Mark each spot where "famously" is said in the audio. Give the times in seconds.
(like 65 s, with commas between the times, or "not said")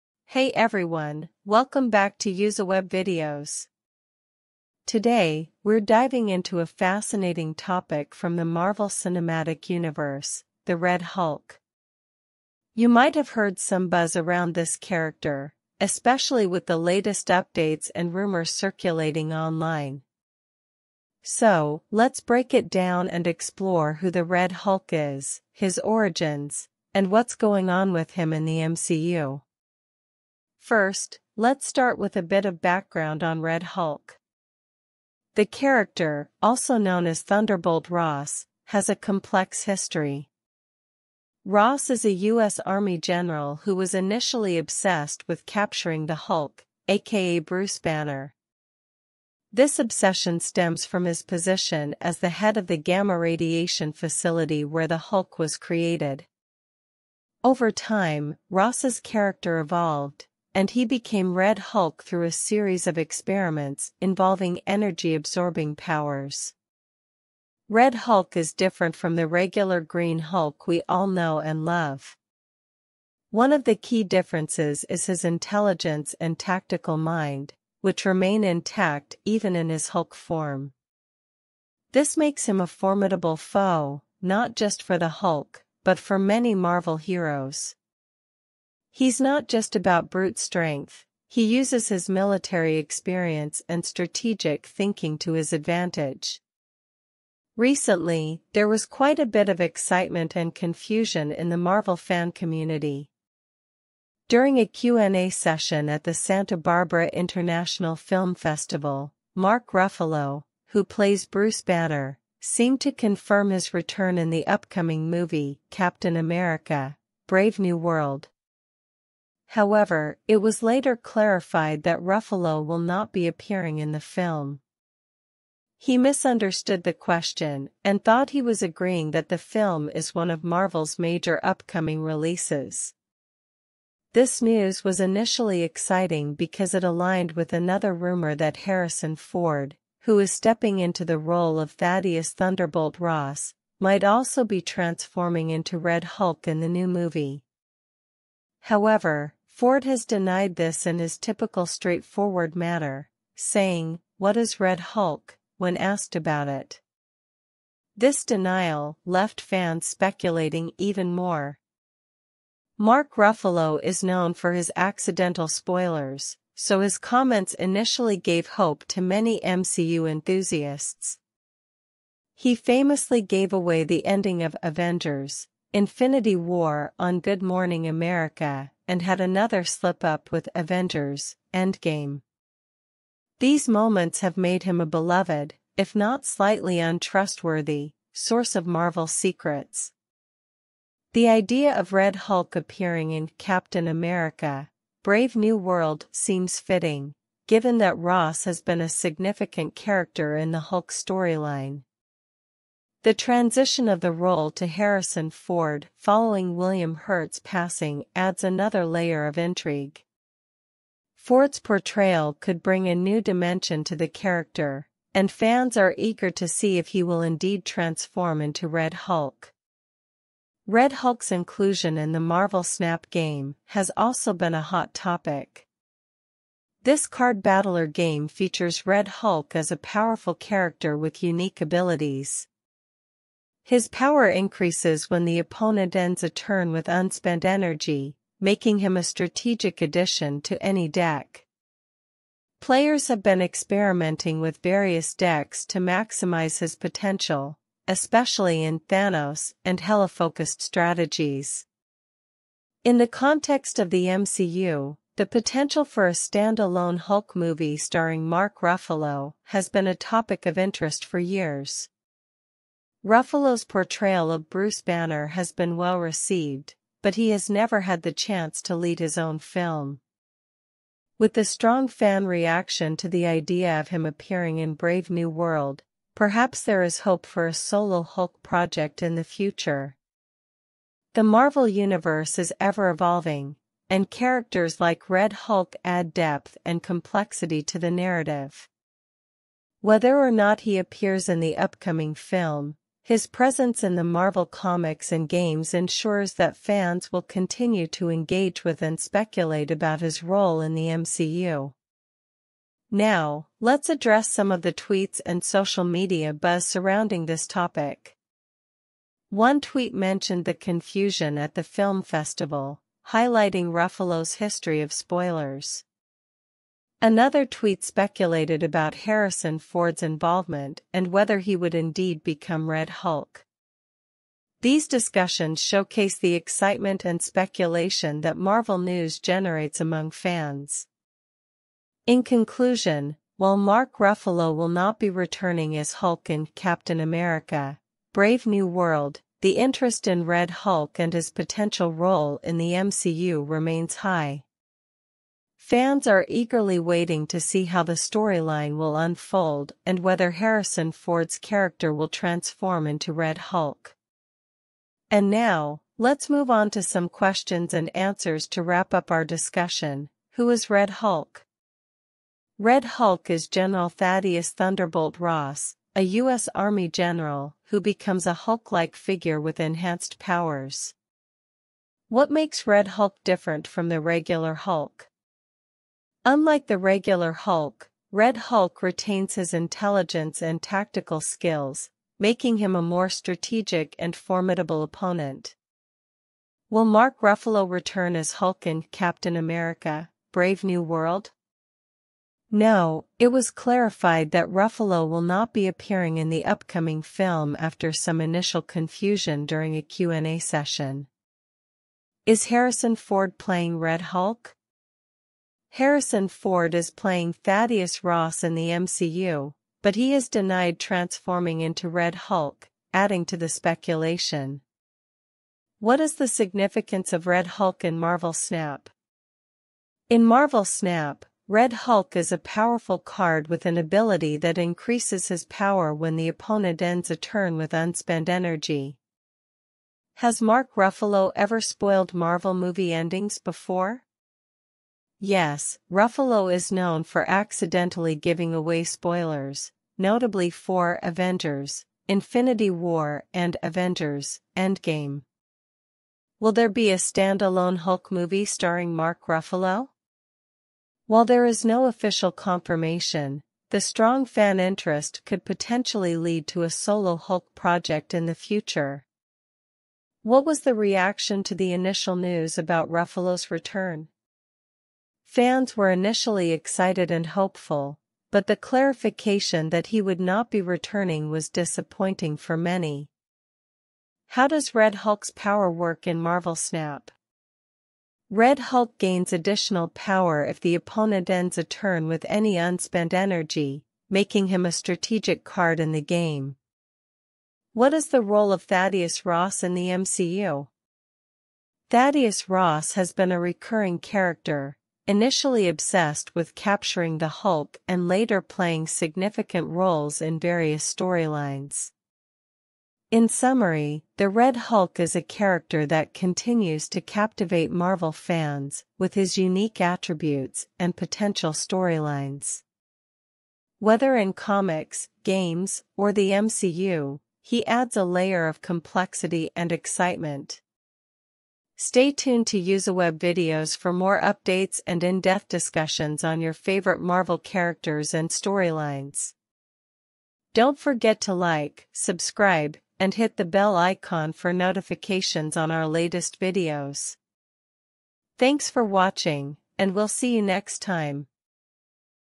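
172 s.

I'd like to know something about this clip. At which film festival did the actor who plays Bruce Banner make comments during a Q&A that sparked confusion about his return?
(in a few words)
Santa Barbara International Film Festival.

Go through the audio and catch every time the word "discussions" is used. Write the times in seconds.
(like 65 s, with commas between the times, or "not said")
324 s, 359 s, 525 s.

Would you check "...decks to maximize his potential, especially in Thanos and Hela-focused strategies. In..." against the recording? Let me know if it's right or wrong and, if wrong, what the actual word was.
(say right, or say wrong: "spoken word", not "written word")
right.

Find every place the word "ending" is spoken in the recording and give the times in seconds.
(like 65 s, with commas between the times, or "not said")
174 s, 432 s.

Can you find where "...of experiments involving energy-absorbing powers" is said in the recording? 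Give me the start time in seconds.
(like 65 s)
62 s.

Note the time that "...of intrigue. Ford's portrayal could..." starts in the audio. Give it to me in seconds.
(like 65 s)
209 s.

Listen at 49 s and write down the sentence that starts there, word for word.
This obsession stems from his position as the head of the gamma radiation facility where the Hulk was created.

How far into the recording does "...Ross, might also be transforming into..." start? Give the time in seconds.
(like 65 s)
143 s.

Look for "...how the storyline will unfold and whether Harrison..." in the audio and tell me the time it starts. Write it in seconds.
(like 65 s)
347 s.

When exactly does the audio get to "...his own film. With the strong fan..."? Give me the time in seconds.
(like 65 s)
268 s.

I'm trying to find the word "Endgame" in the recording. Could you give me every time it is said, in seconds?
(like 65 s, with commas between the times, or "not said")
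181 s, 444 s.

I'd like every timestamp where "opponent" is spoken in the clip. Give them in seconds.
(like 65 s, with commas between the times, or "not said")
235 s, 384 s, 426 s, 480 s.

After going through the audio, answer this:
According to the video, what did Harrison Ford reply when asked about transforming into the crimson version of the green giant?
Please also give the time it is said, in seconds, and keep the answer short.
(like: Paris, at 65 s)
What is Red Hulk, at 154 s.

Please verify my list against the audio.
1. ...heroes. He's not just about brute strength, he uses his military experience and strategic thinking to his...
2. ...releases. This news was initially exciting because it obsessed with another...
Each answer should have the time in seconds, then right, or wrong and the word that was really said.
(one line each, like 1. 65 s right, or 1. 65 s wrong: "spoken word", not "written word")
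1. 86 s right
2. 131 s wrong: "aligned", not "obsessed".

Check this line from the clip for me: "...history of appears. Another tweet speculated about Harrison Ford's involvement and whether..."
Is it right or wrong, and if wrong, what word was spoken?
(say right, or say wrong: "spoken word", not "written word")
wrong: "spoilers", not "appears".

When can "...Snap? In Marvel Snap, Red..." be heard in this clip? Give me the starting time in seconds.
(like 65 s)
418 s.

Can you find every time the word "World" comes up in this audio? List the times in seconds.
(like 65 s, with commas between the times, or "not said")
117 s, 195 s, 275 s, 338 s, 390 s.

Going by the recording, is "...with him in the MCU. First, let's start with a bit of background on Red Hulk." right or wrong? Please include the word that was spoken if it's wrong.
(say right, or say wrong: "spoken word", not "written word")
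right.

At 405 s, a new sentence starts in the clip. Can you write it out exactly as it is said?
Harrison Ford is playing Thaddeus Ross in the MCU, but he is denied transforming into Red Hulk, adding to the speculation.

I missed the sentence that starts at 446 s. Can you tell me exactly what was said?
Will there be a standalone Hulk movie starring Mark Ruffalo?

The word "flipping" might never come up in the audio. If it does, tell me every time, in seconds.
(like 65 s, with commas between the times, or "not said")
not said.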